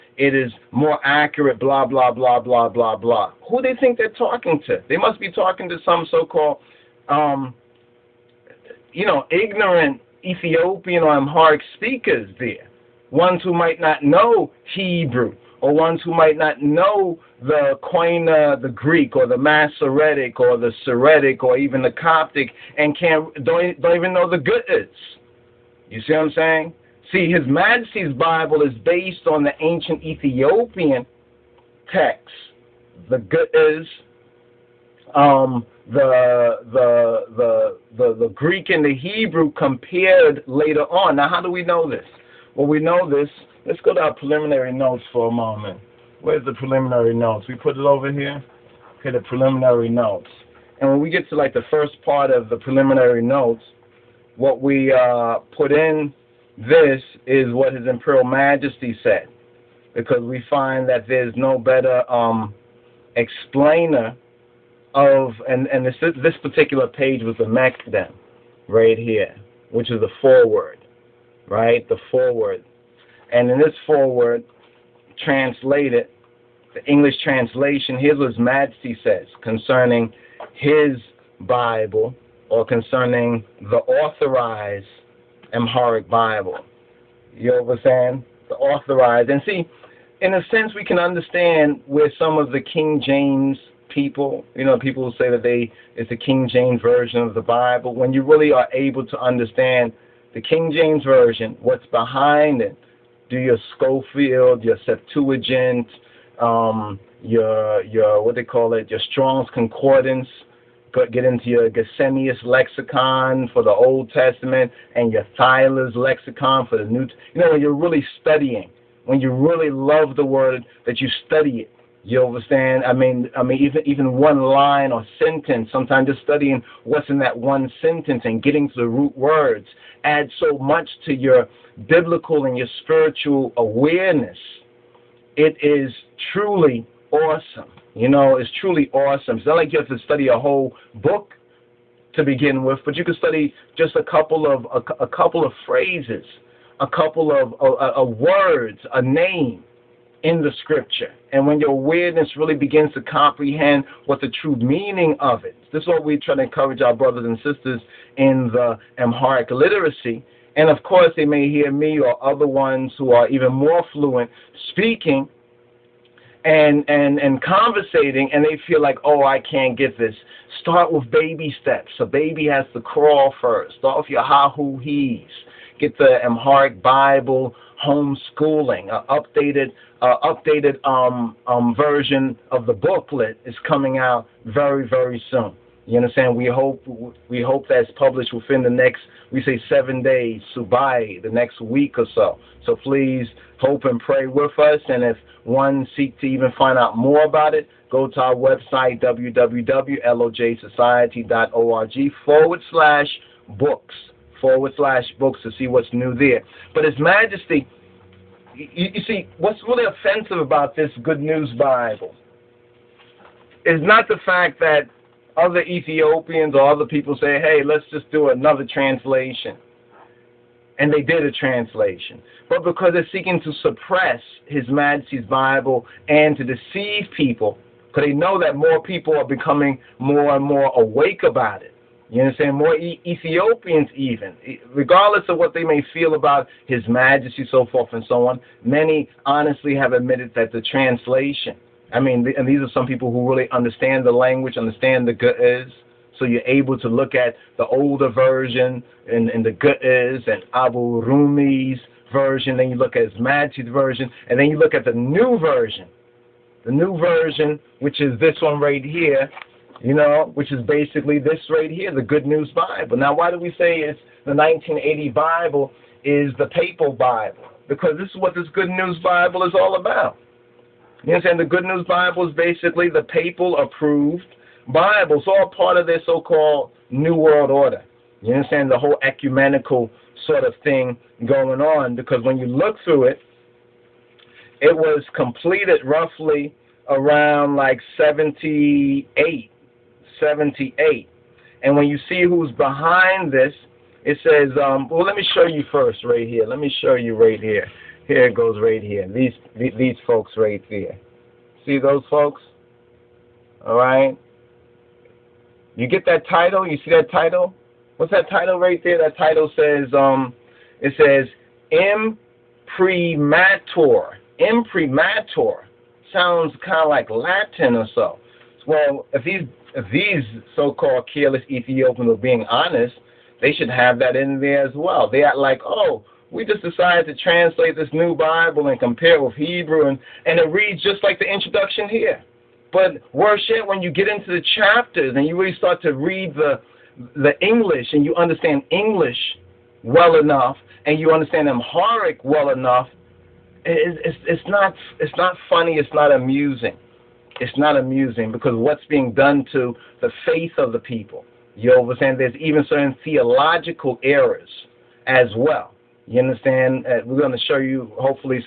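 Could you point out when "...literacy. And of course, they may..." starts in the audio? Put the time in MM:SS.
02:39.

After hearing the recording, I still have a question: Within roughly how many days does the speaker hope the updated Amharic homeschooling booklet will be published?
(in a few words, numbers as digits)
7.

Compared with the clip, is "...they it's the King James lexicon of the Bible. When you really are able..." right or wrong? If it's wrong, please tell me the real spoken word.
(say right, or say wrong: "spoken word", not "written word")
wrong: "version", not "lexicon".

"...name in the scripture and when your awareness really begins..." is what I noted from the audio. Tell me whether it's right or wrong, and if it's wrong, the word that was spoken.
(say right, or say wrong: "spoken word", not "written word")
right.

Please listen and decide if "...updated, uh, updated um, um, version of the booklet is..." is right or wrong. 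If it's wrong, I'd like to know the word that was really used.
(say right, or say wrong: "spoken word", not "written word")
right.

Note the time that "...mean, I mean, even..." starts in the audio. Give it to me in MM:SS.
02:02.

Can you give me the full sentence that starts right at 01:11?
The foreword, and in this foreword, translated, the English translation.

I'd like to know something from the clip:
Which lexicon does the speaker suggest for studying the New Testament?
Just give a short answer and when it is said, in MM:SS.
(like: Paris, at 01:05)
Thayer's lexicon, at 01:55.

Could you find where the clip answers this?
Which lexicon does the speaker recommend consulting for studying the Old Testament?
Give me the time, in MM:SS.
01:51.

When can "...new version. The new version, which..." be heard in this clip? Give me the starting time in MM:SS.
04:14.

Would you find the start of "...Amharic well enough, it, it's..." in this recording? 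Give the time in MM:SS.
05:41.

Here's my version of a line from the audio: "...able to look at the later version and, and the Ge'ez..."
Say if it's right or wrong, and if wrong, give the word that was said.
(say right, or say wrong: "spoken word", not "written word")
wrong: "older", not "later".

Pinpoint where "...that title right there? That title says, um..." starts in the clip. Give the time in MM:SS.
05:08.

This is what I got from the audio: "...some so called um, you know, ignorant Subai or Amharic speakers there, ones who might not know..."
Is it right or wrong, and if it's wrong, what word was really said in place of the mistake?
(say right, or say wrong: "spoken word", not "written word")
wrong: "Ethiopian", not "Subai".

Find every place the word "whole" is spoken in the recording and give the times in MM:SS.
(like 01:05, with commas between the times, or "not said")
02:20, 04:38.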